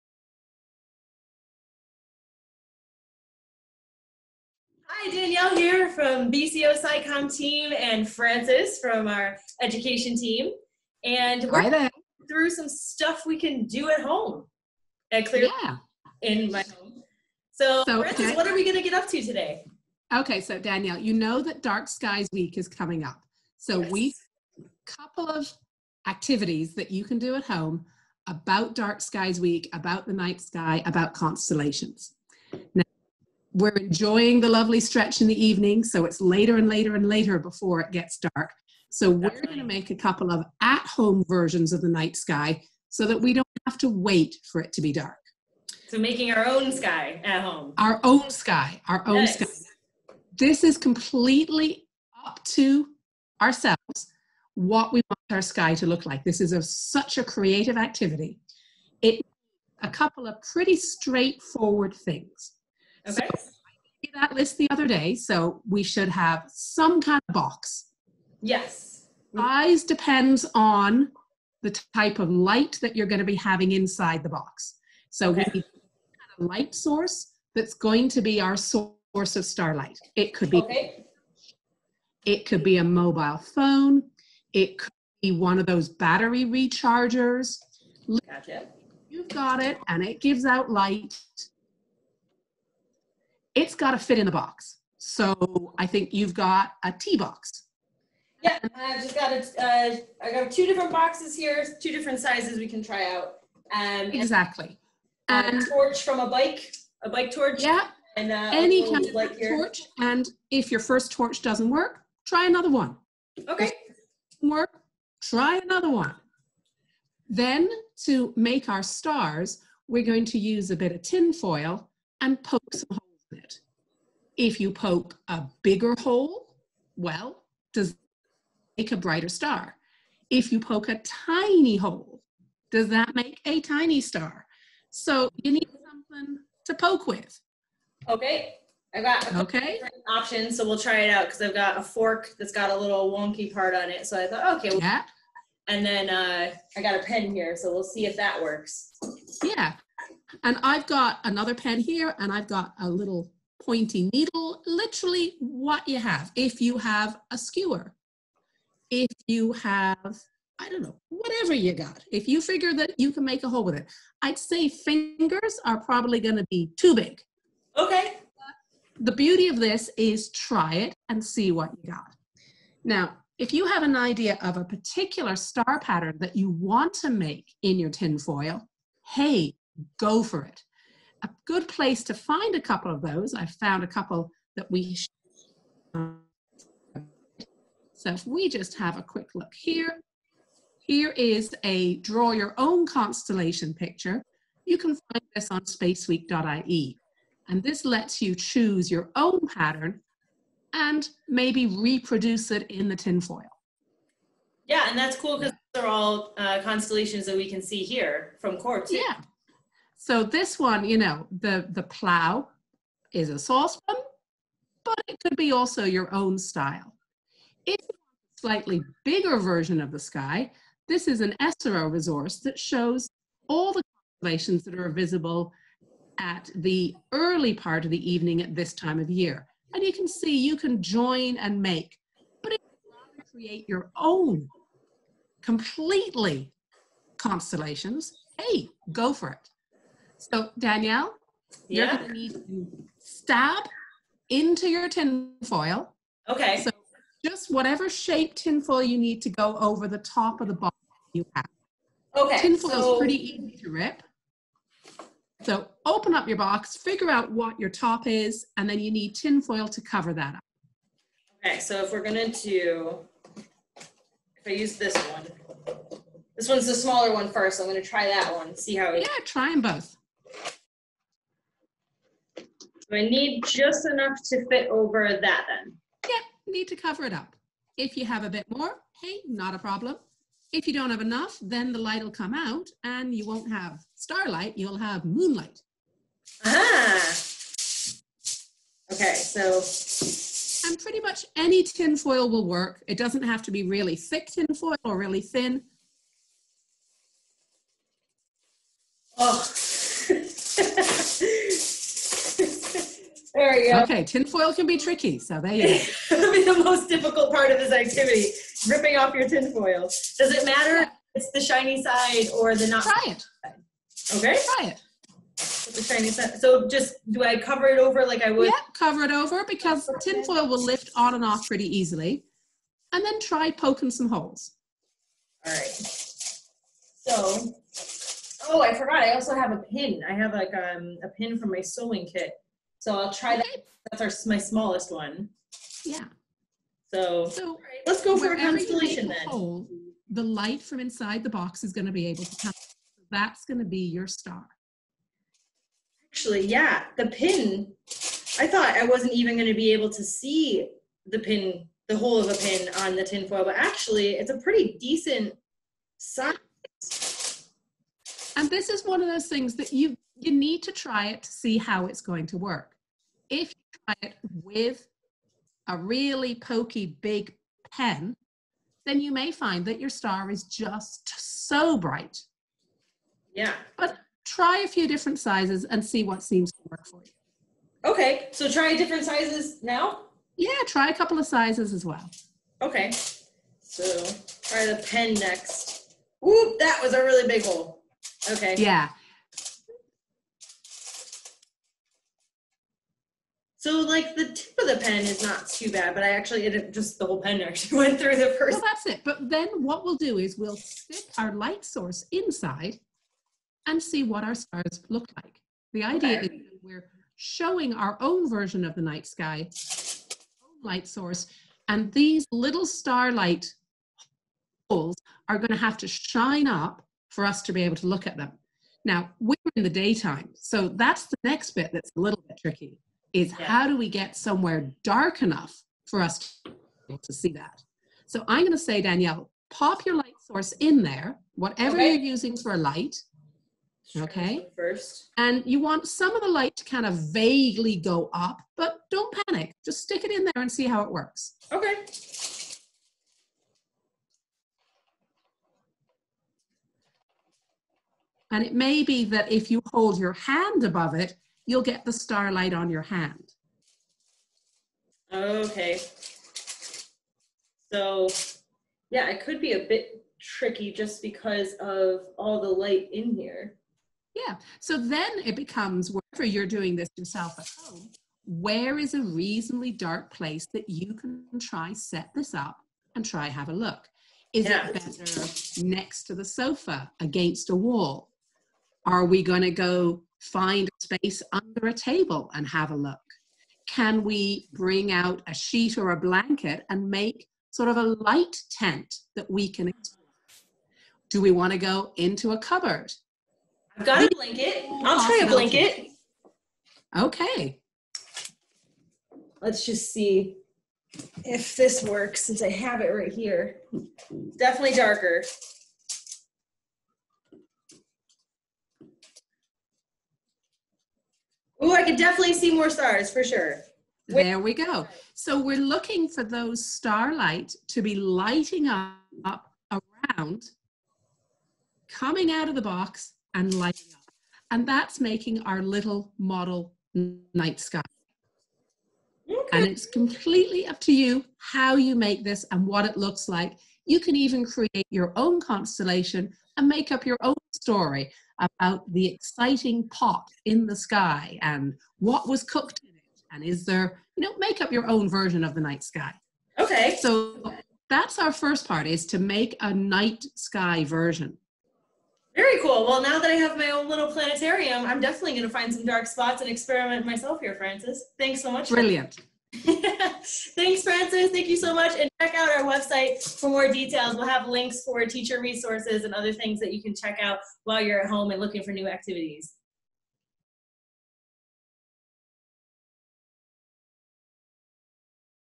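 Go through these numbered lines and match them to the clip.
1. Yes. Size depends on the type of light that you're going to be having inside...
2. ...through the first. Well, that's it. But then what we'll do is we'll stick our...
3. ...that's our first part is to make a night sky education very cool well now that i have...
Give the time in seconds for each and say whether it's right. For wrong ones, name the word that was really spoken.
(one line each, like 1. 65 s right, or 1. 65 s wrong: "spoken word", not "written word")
1. 68 s right
2. 397 s right
3. 547 s wrong: "version", not "education".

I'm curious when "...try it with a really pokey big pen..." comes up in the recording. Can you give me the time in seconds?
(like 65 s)
363 s.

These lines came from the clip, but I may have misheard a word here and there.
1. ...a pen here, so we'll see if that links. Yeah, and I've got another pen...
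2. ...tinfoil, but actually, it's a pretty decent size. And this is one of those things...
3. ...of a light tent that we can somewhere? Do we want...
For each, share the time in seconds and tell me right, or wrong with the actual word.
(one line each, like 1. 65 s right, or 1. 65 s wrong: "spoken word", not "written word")
1. 146 s wrong: "works", not "links"
2. 353 s right
3. 487 s wrong: "explore", not "somewhere".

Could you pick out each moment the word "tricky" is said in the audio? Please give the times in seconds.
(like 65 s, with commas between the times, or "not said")
304 s, 422 s, 460 s.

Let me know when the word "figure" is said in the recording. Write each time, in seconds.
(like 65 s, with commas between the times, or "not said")
162 s, 256 s.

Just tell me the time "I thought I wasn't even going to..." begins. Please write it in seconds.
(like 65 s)
348 s.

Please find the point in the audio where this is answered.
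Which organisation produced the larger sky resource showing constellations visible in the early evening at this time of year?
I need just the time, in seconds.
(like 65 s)
221 s.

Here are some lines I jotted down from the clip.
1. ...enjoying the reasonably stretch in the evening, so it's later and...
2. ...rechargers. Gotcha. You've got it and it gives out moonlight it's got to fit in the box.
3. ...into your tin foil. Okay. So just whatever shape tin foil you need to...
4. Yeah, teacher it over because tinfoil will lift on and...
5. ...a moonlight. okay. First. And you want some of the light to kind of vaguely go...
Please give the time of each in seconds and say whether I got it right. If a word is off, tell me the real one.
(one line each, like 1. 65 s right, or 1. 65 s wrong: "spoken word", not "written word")
1. 33 s wrong: "lovely", not "reasonably"
2. 86 s wrong: "light", not "moonlight"
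3. 244 s right
4. 318 s wrong: "cover", not "teacher"
5. 432 s wrong: "light", not "moonlight".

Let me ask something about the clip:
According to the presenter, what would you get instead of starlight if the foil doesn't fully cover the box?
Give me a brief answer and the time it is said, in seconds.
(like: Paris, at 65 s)
moonlight, at 285 s.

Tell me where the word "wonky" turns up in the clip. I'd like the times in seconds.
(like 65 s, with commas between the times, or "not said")
143 s.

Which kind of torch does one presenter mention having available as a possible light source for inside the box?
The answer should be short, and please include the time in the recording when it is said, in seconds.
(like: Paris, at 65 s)
bike torch, at 107 s.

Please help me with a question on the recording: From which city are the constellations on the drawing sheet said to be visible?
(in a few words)
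Cork.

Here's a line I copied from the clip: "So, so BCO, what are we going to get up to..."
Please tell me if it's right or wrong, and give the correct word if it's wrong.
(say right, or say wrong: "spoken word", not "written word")
wrong: "Frances", not "BCO".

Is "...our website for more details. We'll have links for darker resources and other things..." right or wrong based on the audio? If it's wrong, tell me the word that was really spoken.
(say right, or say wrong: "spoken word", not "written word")
wrong: "teacher", not "darker".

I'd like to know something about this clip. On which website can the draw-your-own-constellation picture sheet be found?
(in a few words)
spaceweek.ie.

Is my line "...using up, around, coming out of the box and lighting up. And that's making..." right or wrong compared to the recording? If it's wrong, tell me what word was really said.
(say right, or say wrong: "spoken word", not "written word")
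wrong: "lighting", not "using".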